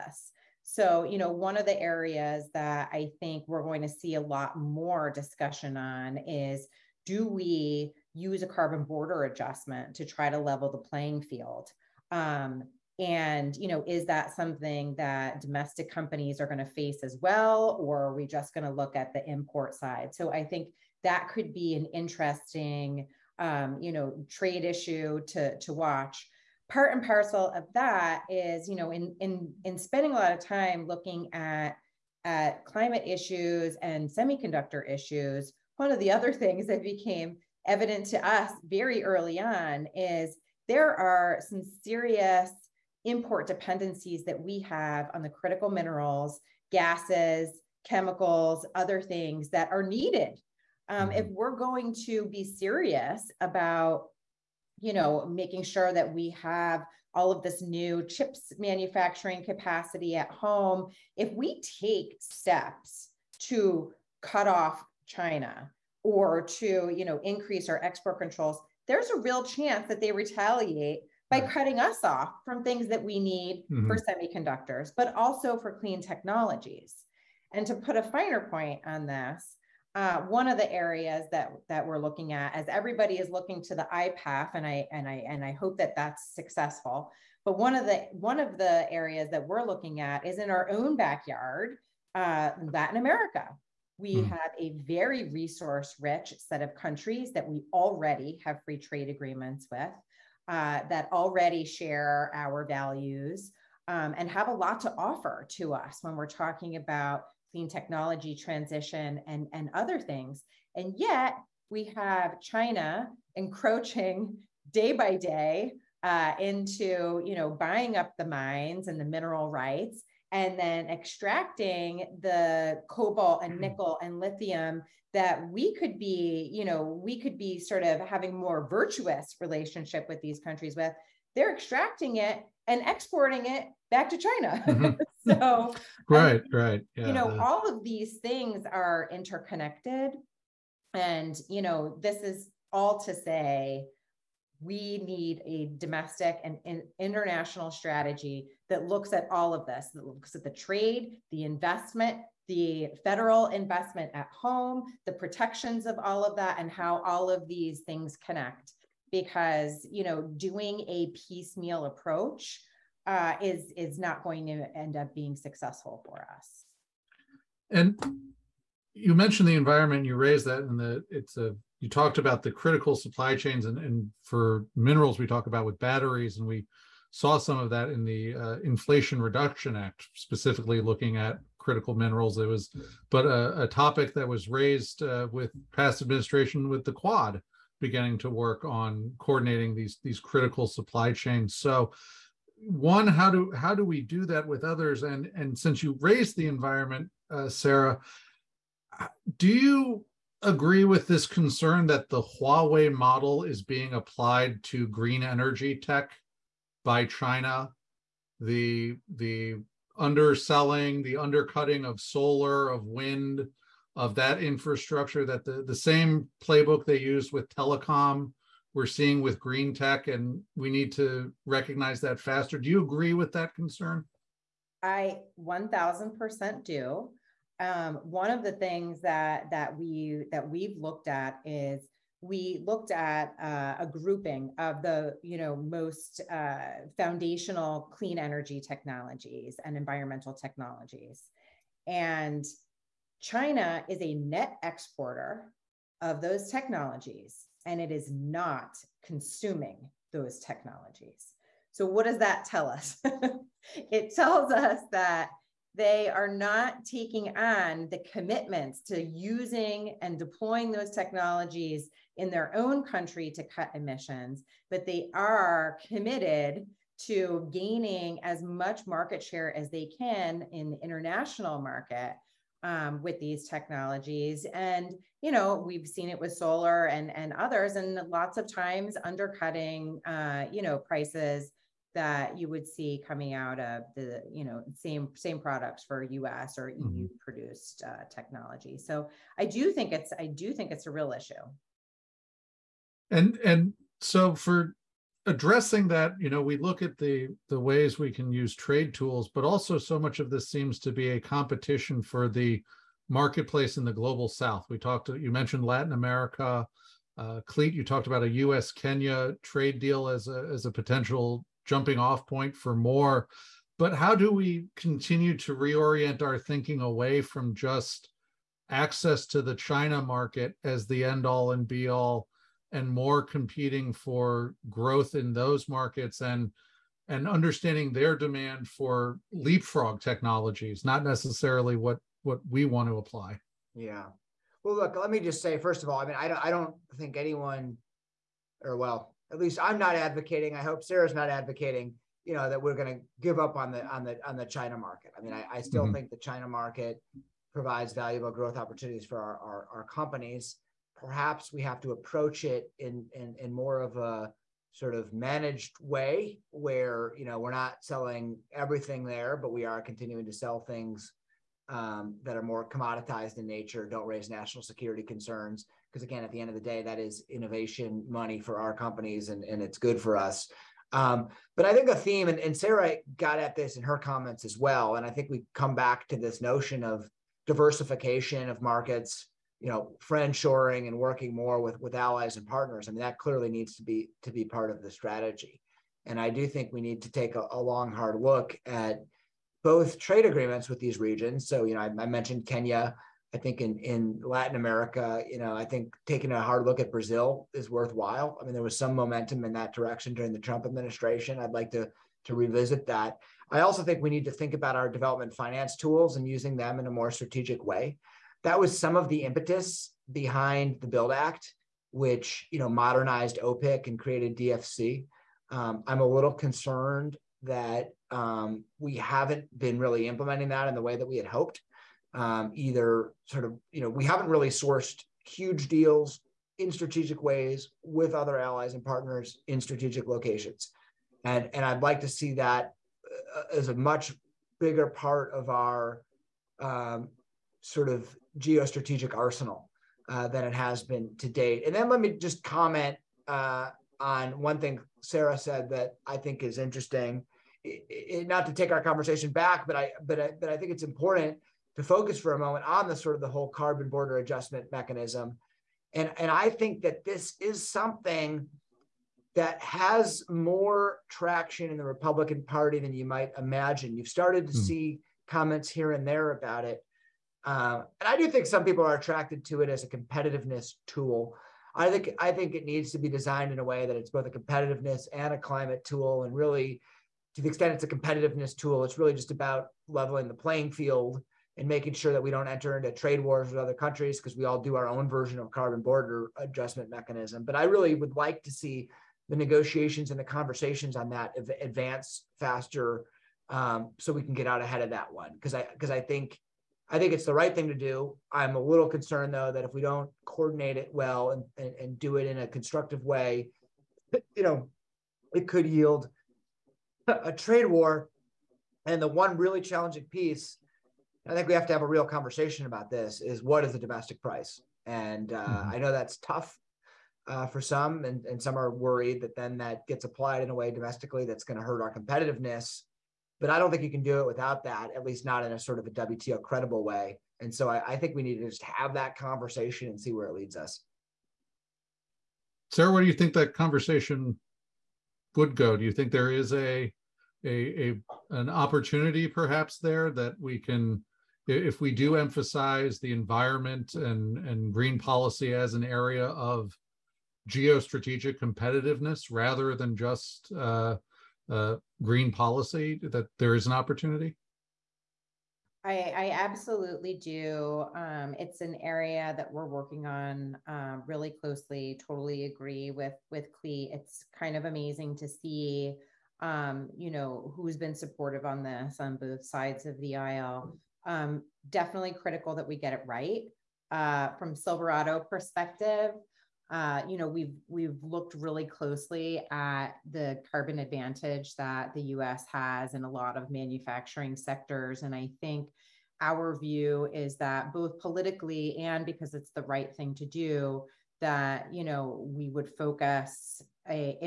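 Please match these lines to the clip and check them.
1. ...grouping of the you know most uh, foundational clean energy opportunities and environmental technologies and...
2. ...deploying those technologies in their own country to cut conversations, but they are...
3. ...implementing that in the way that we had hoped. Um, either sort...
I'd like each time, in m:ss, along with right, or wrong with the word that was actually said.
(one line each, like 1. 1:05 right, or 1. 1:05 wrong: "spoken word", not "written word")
1. 3:53 wrong: "technologies", not "opportunities"
2. 4:20 wrong: "emissions", not "conversations"
3. 7:00 right.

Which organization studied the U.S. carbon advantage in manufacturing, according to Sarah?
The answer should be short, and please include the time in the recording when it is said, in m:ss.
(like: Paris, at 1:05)
Silverado, at 9:34.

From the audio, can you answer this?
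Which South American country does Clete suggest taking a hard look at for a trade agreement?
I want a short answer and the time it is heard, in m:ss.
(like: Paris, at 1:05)
Brazil, at 6:36.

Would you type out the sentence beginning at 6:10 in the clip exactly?
Um, but I think a theme, and, and Sarah got at this in her comments as well.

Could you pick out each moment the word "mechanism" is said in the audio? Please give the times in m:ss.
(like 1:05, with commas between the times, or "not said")
7:34, 8:06.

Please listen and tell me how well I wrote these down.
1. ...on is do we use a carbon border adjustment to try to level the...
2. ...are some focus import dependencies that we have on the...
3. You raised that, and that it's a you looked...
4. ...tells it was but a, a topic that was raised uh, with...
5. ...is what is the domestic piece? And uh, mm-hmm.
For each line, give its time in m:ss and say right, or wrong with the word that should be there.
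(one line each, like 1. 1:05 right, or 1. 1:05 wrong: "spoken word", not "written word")
1. 0:05 right
2. 0:40 wrong: "serious", not "focus"
3. 2:50 wrong: "talked", not "looked"
4. 3:01 wrong: "minerals", not "tells"
5. 8:33 wrong: "price", not "piece".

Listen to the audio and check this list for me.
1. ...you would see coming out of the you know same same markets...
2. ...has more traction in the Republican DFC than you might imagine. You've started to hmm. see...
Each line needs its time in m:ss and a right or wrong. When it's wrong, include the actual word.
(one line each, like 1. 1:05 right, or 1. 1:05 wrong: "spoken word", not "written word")
1. 4:42 wrong: "products", not "markets"
2. 7:39 wrong: "Party", not "DFC".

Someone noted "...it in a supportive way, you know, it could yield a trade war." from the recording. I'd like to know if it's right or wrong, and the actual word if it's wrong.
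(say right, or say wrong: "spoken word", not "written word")
wrong: "constructive", not "supportive".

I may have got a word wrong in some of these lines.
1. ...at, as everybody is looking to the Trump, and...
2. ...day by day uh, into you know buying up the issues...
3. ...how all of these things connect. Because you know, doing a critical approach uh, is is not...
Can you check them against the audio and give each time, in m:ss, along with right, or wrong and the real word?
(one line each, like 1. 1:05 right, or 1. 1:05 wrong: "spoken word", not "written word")
1. 1:22 wrong: "IPEF", not "Trump"
2. 1:54 wrong: "mines", not "issues"
3. 2:36 wrong: "piecemeal", not "critical".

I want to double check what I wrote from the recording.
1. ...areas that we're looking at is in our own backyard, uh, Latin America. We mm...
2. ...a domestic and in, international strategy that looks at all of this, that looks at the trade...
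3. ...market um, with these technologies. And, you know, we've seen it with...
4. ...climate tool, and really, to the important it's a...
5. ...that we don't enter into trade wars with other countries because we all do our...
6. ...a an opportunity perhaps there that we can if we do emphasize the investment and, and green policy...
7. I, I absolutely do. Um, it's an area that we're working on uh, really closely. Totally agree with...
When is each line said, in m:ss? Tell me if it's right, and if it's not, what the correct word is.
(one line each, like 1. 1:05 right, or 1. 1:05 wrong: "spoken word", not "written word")
1. 1:28 right
2. 2:25 right
3. 4:31 right
4. 7:55 wrong: "extent", not "important"
5. 8:02 right
6. 8:57 wrong: "environment", not "investment"
7. 9:15 right.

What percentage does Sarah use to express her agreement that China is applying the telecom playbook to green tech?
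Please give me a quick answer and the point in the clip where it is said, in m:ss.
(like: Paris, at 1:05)
1000%, at 3:45.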